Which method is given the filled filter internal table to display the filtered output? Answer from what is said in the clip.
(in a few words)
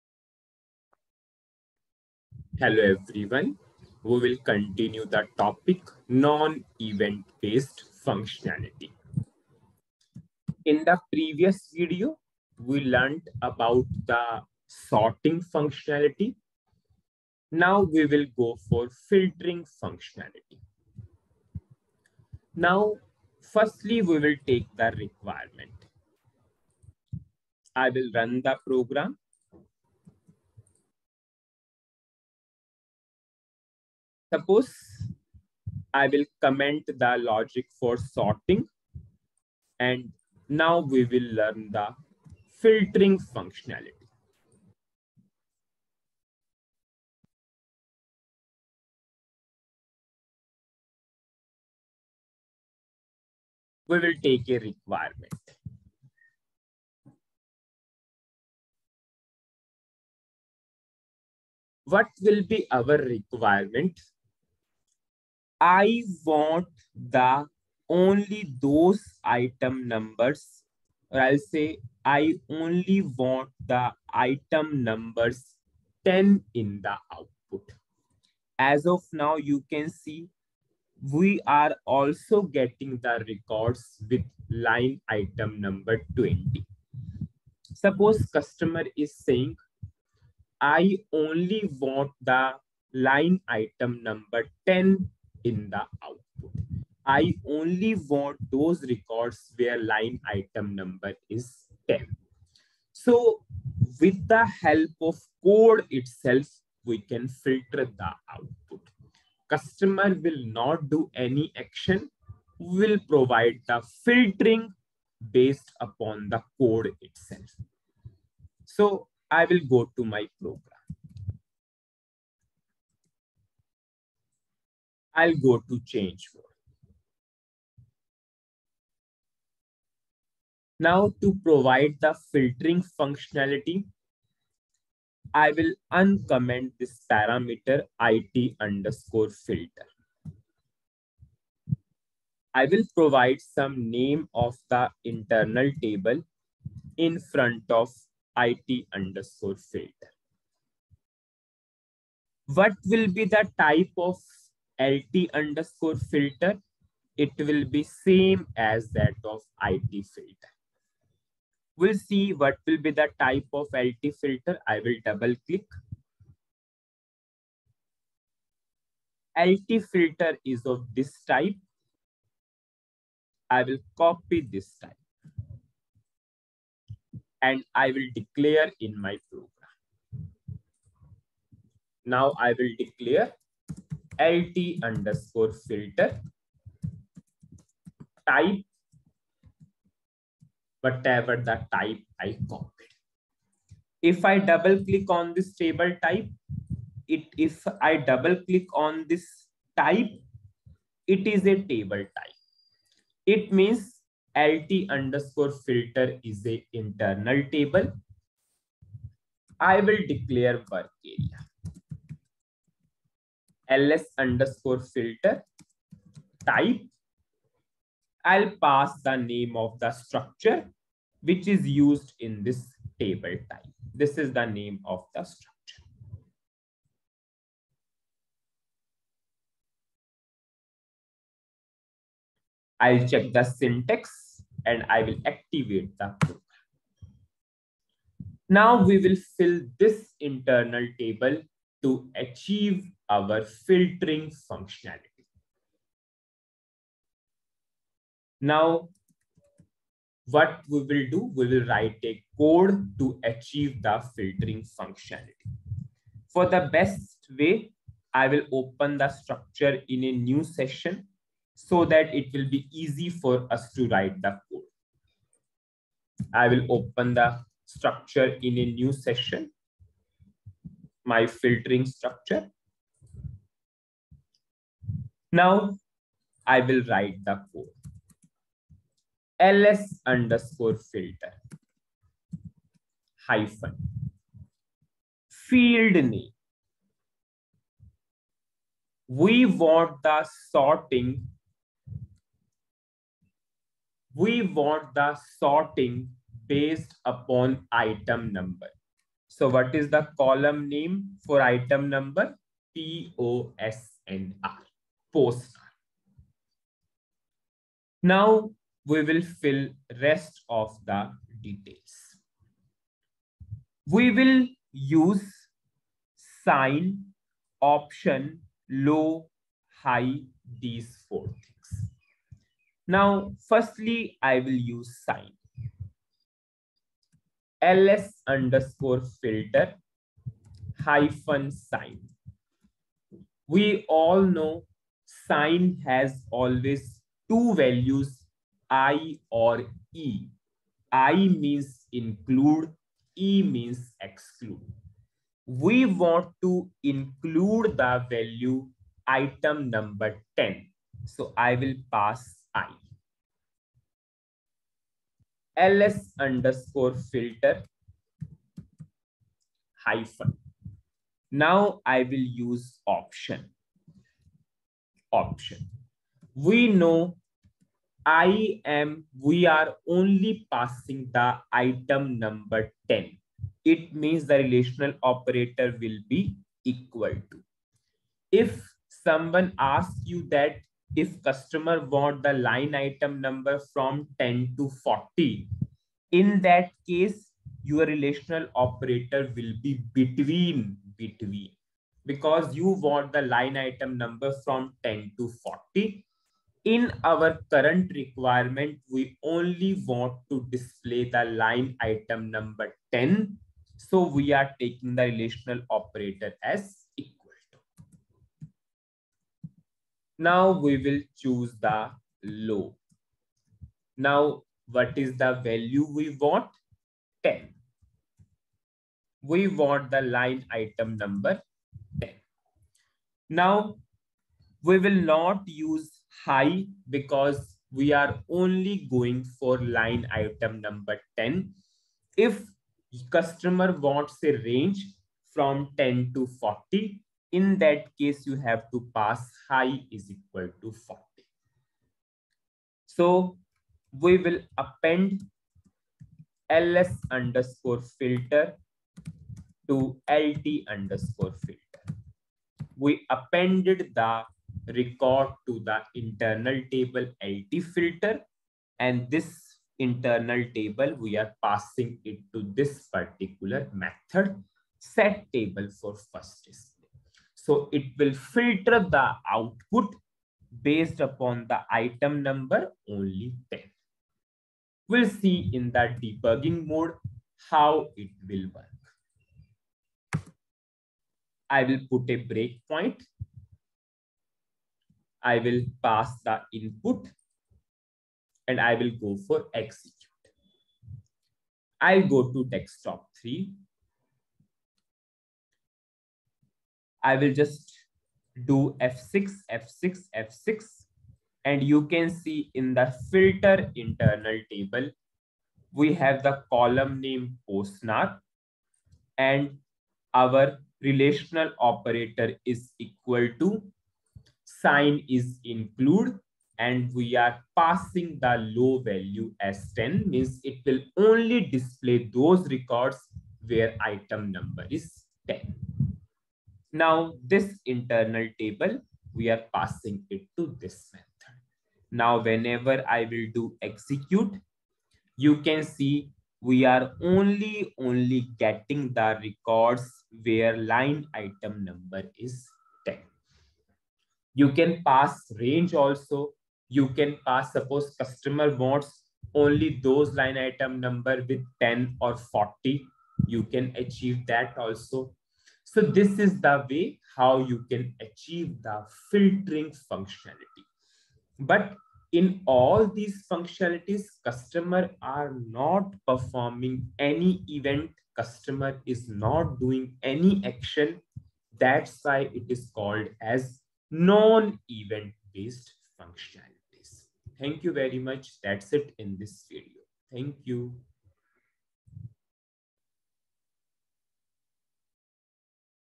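set table for first display.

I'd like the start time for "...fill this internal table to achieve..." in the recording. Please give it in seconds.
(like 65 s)
239 s.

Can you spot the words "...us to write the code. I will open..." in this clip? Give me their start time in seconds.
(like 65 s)
263 s.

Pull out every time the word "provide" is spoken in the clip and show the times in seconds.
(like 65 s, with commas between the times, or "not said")
113 s, 131 s, 142 s.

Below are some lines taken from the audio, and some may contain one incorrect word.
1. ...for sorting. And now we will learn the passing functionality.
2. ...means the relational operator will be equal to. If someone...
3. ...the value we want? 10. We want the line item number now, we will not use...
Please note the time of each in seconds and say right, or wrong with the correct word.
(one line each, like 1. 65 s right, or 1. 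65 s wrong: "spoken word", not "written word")
1. 37 s wrong: "filtering", not "passing"
2. 373 s right
3. 415 s right.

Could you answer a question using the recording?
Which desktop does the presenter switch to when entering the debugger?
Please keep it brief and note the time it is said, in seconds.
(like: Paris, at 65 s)
Desktop 3, at 492 s.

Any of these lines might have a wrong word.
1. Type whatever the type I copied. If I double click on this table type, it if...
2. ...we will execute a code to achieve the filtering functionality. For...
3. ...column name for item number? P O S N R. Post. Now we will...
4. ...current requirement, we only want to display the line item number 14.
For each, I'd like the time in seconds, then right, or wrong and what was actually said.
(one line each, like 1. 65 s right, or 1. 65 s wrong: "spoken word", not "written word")
1. 188 s right
2. 251 s wrong: "write", not "execute"
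3. 300 s right
4. 397 s wrong: "10", not "14".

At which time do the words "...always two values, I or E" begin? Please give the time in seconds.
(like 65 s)
336 s.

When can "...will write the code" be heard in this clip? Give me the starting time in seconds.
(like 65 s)
276 s.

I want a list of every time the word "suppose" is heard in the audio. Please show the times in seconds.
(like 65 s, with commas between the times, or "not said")
34 s, 87 s, 547 s.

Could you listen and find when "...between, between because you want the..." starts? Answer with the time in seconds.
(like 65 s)
389 s.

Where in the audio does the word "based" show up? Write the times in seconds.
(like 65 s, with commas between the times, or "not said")
7 s, 115 s, 296 s, 470 s, 575 s.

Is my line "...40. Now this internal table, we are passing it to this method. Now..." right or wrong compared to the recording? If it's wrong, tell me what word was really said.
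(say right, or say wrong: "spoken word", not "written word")
wrong: "10", not "40".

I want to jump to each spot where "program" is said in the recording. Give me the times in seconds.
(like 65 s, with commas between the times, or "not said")
28 s, 120 s, 179 s, 236 s.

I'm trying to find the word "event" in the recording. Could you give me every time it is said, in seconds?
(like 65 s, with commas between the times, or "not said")
6 s, 567 s, 573 s.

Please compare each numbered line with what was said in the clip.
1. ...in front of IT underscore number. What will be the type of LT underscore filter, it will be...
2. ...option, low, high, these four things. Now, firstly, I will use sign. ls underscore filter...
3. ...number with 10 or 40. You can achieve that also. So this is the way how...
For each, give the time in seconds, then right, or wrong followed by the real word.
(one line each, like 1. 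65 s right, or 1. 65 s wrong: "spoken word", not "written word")
1. 146 s wrong: "filter", not "number"
2. 317 s right
3. 550 s right.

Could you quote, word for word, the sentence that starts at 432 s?
If customer wants a range from 10 to 40, in that case, you have to pass high is equal to 40.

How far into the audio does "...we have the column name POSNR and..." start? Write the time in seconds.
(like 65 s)
505 s.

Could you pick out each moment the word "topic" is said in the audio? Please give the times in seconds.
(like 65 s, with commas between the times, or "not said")
5 s.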